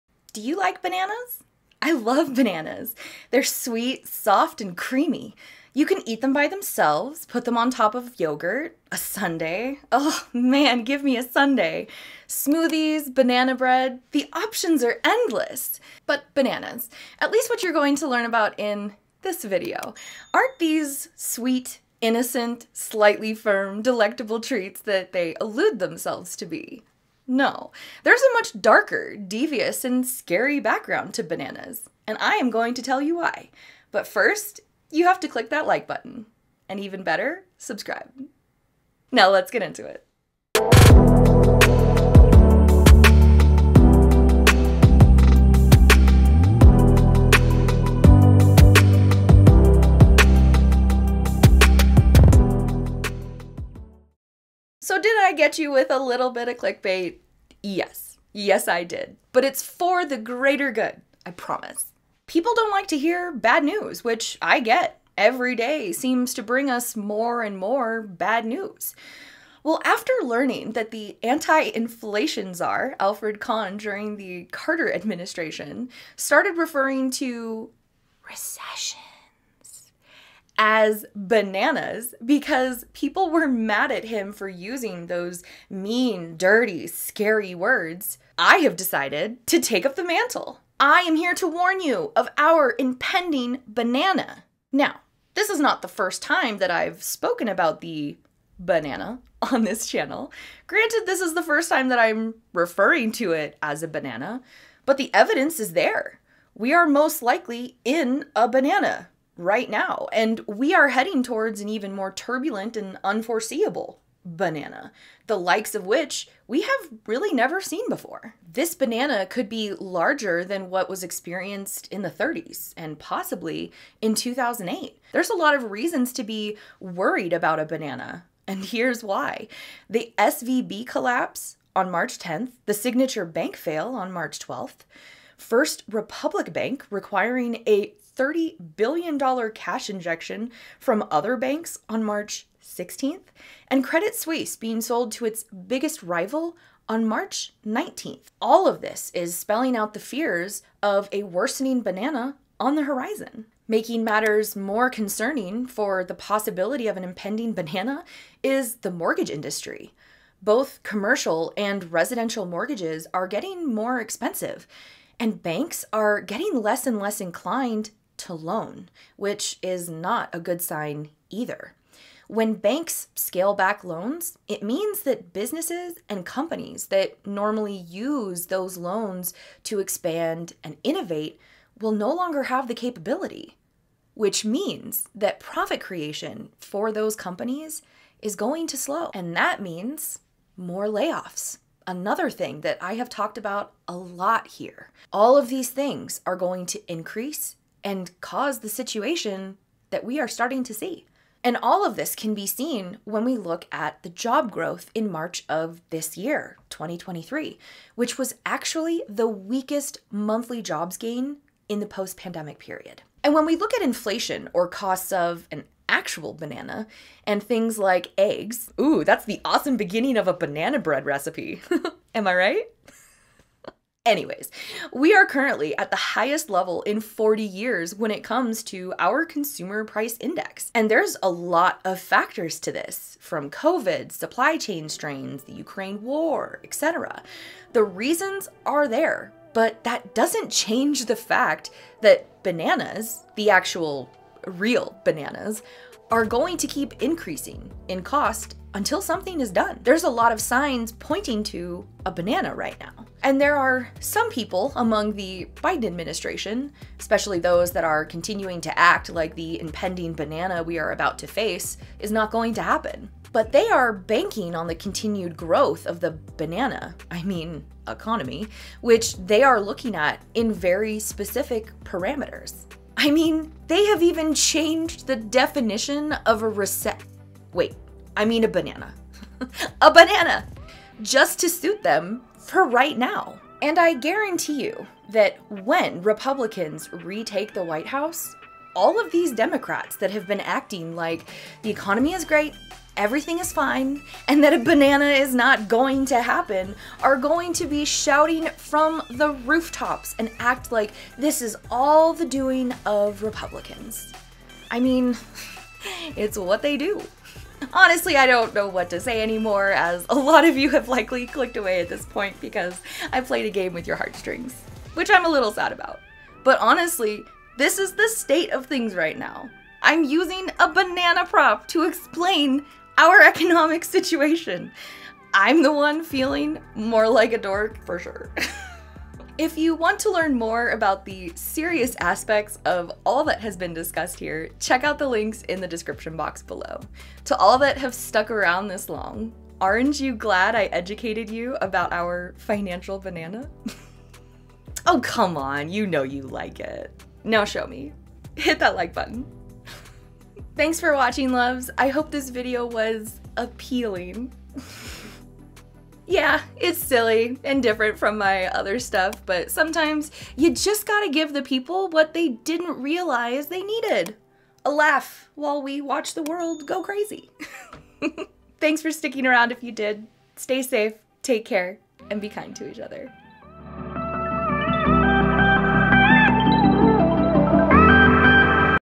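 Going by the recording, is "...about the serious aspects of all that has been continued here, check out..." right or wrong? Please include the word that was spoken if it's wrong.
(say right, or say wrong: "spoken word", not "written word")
wrong: "discussed", not "continued".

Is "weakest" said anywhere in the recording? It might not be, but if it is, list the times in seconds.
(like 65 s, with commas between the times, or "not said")
209 s.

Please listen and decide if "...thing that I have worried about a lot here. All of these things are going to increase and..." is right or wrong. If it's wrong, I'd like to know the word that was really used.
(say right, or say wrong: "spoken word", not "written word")
wrong: "talked", not "worried".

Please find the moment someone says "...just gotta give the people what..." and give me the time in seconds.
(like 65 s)
360 s.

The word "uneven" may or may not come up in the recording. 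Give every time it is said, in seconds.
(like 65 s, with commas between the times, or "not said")
not said.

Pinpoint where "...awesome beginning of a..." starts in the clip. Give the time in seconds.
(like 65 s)
219 s.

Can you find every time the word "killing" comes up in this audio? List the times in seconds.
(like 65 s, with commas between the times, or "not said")
not said.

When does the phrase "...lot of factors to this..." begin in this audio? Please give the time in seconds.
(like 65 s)
231 s.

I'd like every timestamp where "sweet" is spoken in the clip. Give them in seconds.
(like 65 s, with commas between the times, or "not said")
3 s, 21 s.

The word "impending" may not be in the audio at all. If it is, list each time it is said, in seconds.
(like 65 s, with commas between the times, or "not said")
92 s, 157 s, 259 s.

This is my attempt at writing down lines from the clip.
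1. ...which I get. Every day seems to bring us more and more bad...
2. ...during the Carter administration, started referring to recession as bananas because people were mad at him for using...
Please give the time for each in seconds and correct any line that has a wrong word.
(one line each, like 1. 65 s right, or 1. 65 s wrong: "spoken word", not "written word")
1. 64 s right
2. 73 s right.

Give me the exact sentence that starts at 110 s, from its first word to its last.
And we are heading towards an even more turbulent and unforeseeable banana, the likes of which we have really never seen before.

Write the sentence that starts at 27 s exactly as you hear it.
No, there's a much darker, devious, and scary background to bananas, and I am going to tell you why.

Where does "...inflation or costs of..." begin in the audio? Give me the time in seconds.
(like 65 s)
213 s.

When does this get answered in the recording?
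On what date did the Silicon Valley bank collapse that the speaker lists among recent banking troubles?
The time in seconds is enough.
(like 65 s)
131 s.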